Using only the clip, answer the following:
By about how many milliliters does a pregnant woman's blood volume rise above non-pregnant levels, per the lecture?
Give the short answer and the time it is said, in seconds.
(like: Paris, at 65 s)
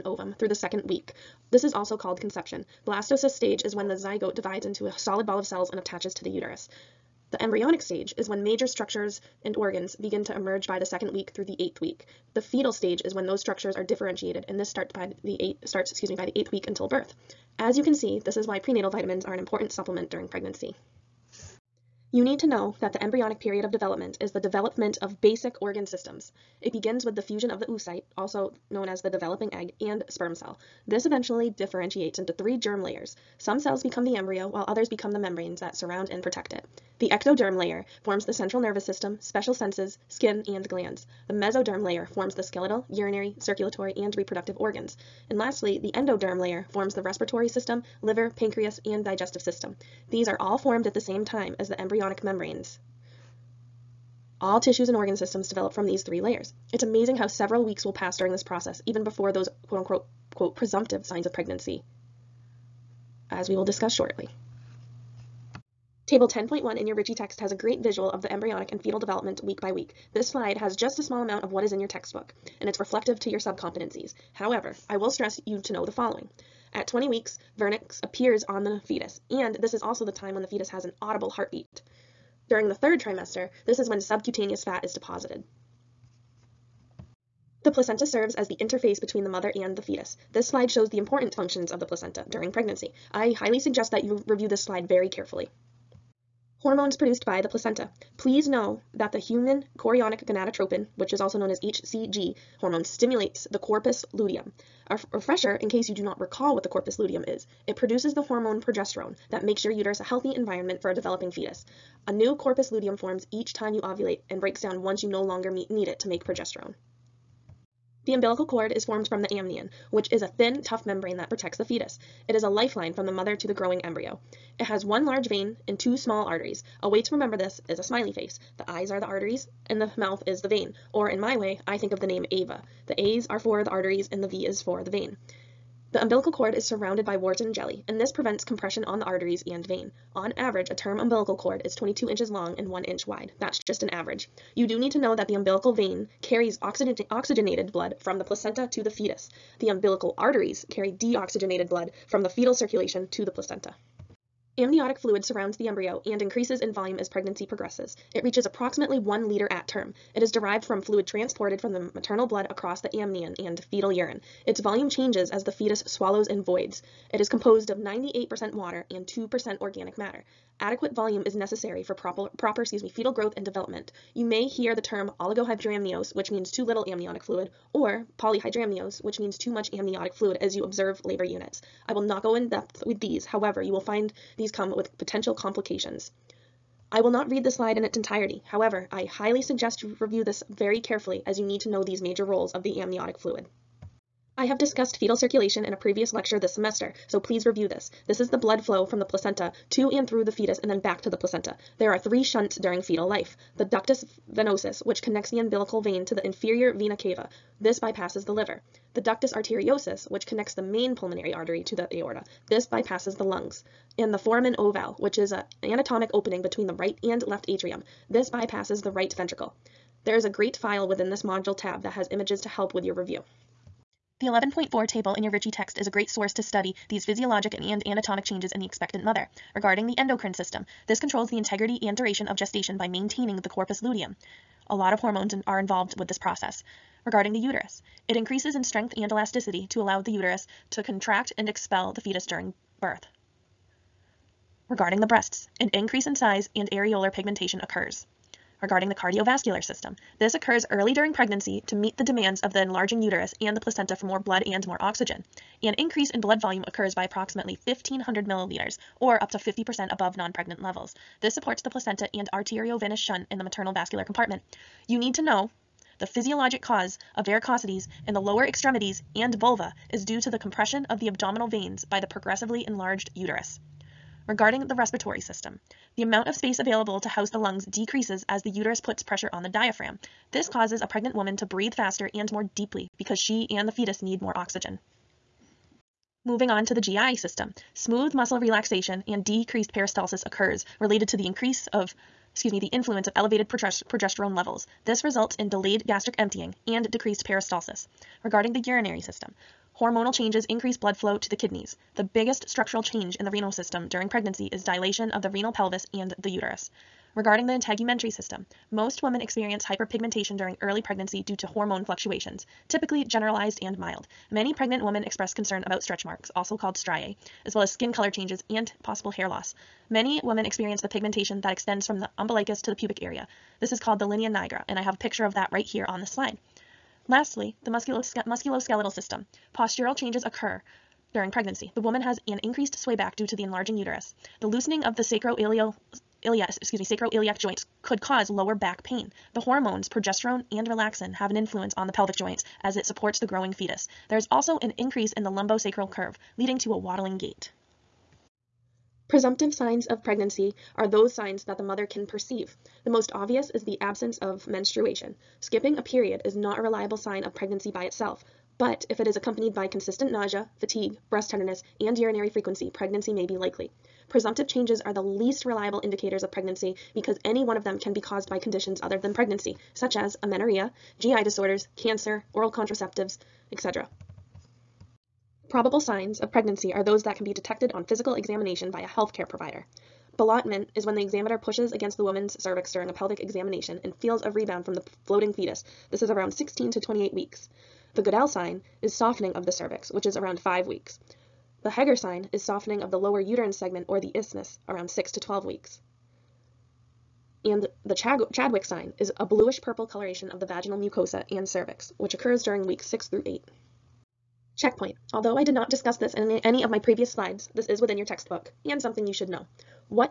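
1500 milliliters, at 257 s.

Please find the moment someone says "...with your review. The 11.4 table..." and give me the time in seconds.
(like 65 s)
222 s.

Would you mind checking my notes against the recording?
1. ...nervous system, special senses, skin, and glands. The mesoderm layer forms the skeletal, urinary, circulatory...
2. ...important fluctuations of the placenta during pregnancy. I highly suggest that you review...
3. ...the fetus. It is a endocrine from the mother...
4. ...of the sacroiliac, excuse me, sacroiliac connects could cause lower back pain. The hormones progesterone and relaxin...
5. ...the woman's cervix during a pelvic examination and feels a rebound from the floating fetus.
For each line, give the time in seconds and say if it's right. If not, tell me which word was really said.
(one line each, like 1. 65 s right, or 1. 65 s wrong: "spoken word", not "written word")
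1. 38 s right
2. 90 s wrong: "functions", not "fluctuations"
3. 121 s wrong: "lifeline", not "endocrine"
4. 334 s wrong: "joints", not "connects"
5. 381 s right.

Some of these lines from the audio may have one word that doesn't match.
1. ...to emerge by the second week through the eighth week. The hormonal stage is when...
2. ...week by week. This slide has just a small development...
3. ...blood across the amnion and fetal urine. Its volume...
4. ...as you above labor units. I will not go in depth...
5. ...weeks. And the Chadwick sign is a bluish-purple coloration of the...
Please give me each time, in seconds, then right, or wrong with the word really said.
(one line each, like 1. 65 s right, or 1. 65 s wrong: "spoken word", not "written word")
1. 10 s wrong: "fetal", not "hormonal"
2. 69 s wrong: "amount", not "development"
3. 162 s right
4. 180 s wrong: "observe", not "above"
5. 395 s right.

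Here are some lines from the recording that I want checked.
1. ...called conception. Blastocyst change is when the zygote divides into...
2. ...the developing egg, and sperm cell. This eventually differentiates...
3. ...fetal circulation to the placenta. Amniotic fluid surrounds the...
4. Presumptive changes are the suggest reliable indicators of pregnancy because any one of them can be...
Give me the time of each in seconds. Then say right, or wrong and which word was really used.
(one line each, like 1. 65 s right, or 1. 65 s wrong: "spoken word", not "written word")
1. 1 s wrong: "stage", not "change"
2. 29 s right
3. 152 s right
4. 364 s wrong: "least", not "suggest".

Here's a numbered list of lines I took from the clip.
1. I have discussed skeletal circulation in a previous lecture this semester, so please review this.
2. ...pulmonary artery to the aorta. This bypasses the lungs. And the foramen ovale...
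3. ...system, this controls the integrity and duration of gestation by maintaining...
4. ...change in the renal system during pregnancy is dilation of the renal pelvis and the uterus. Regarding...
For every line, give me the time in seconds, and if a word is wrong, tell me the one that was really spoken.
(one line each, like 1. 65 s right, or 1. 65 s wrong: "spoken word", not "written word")
1. 194 s wrong: "fetal", not "skeletal"
2. 210 s right
3. 230 s right
4. 302 s right.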